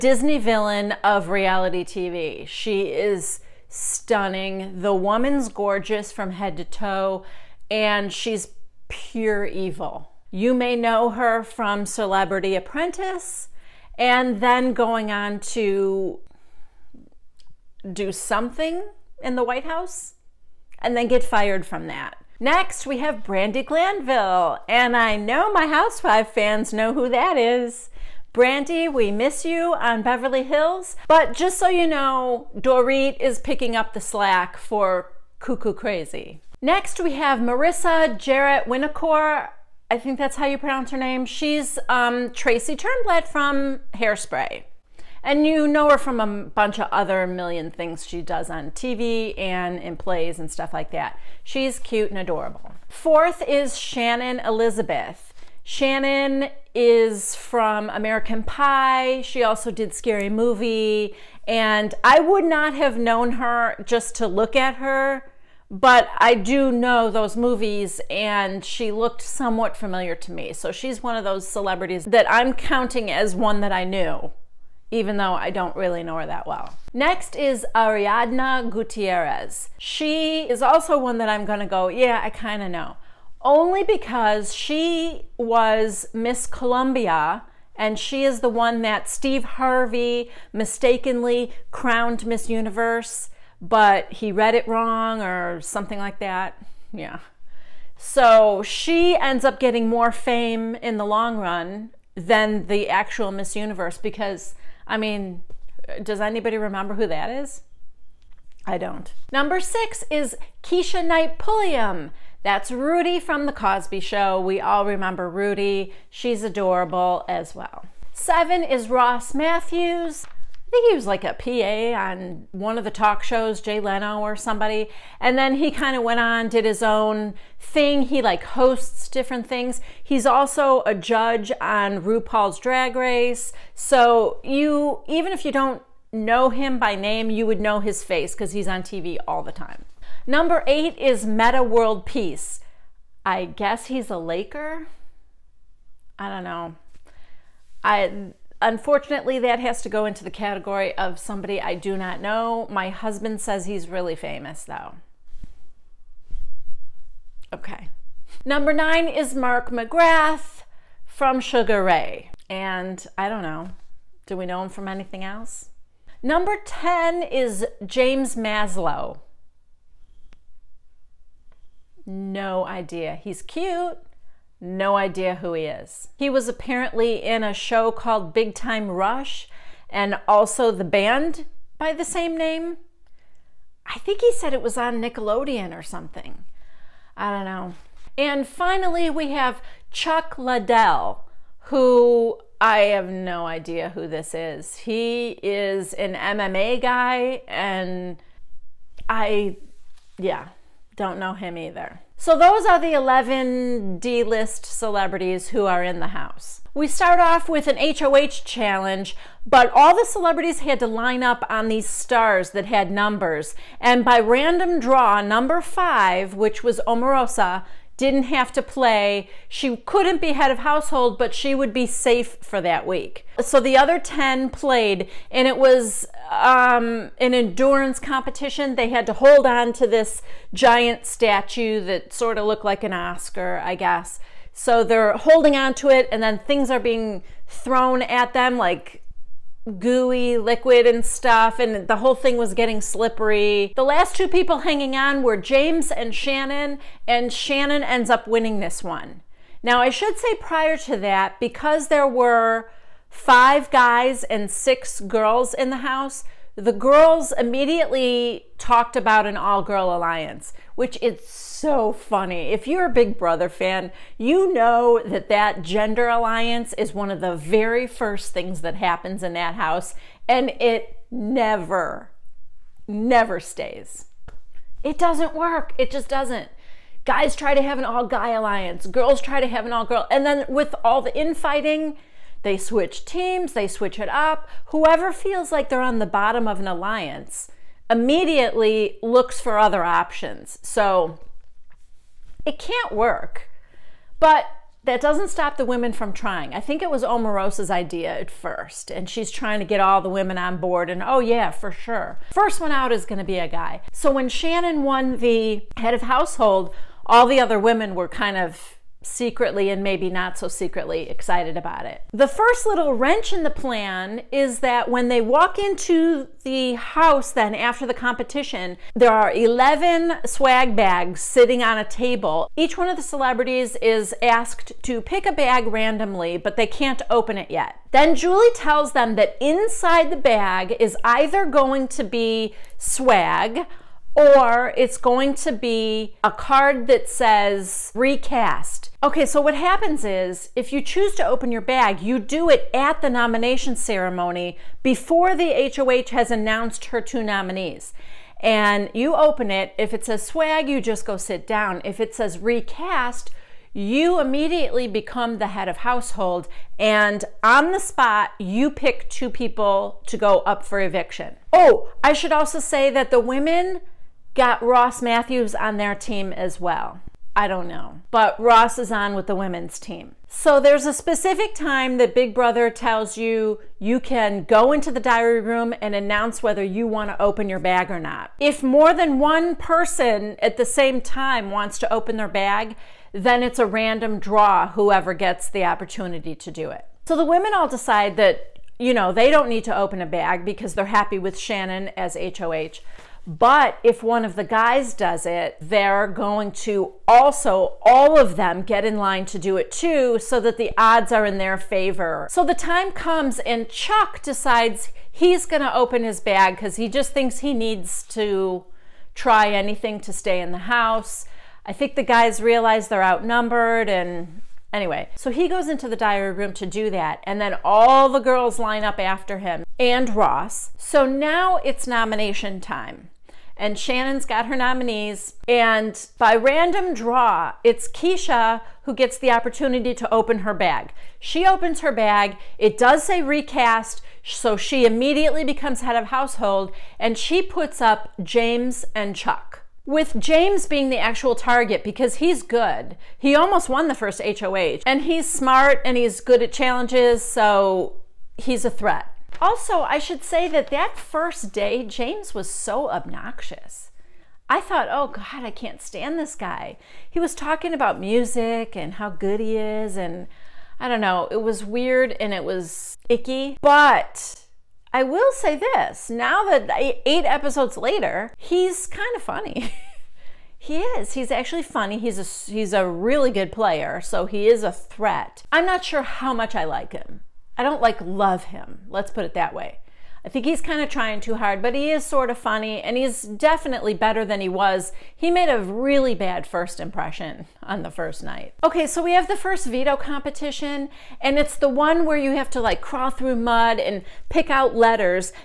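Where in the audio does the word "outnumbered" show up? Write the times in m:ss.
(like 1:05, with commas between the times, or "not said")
6:53.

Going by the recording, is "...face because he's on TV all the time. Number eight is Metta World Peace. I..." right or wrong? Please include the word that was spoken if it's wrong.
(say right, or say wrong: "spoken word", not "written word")
right.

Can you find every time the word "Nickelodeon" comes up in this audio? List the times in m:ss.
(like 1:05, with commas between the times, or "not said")
3:04.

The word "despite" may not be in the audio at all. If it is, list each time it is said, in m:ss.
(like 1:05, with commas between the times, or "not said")
not said.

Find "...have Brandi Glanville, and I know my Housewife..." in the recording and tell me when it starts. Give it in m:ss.
0:22.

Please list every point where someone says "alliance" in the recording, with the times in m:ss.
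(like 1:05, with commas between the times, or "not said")
4:19, 4:26, 4:38, 4:46.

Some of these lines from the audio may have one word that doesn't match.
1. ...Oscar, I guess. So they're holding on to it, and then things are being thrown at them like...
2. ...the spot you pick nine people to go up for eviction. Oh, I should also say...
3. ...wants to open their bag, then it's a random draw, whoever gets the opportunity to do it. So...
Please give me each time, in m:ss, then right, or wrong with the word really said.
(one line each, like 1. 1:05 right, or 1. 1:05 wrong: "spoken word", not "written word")
1. 3:52 right
2. 5:57 wrong: "two", not "nine"
3. 6:21 right.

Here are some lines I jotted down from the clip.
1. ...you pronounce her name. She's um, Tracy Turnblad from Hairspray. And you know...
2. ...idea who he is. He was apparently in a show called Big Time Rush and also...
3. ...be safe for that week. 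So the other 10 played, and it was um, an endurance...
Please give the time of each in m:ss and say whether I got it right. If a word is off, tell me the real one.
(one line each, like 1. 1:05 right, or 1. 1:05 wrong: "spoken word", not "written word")
1. 0:40 right
2. 2:54 right
3. 3:41 right.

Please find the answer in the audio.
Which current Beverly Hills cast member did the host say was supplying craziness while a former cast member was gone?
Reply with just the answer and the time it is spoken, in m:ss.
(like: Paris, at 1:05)
Dorit, at 0:32.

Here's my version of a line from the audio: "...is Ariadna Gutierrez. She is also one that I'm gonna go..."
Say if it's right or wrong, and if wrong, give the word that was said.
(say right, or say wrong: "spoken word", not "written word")
right.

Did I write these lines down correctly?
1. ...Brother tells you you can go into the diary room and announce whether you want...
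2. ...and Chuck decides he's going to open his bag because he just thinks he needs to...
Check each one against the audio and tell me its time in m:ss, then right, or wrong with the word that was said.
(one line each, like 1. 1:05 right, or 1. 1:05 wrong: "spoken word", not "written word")
1. 6:12 right
2. 6:43 right.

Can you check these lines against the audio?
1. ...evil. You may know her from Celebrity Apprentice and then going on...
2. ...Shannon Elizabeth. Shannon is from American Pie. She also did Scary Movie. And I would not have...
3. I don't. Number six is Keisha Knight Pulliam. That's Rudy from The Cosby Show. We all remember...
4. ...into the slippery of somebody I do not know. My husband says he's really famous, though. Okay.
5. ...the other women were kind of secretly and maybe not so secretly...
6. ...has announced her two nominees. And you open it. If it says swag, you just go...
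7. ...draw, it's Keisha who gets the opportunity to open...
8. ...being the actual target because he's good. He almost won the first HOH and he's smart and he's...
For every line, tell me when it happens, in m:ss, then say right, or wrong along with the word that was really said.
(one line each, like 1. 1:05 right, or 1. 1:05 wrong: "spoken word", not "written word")
1. 0:09 right
2. 0:53 right
3. 1:48 right
4. 2:30 wrong: "category", not "slippery"
5. 5:07 right
6. 5:46 right
7. 7:06 right
8. 7:20 right.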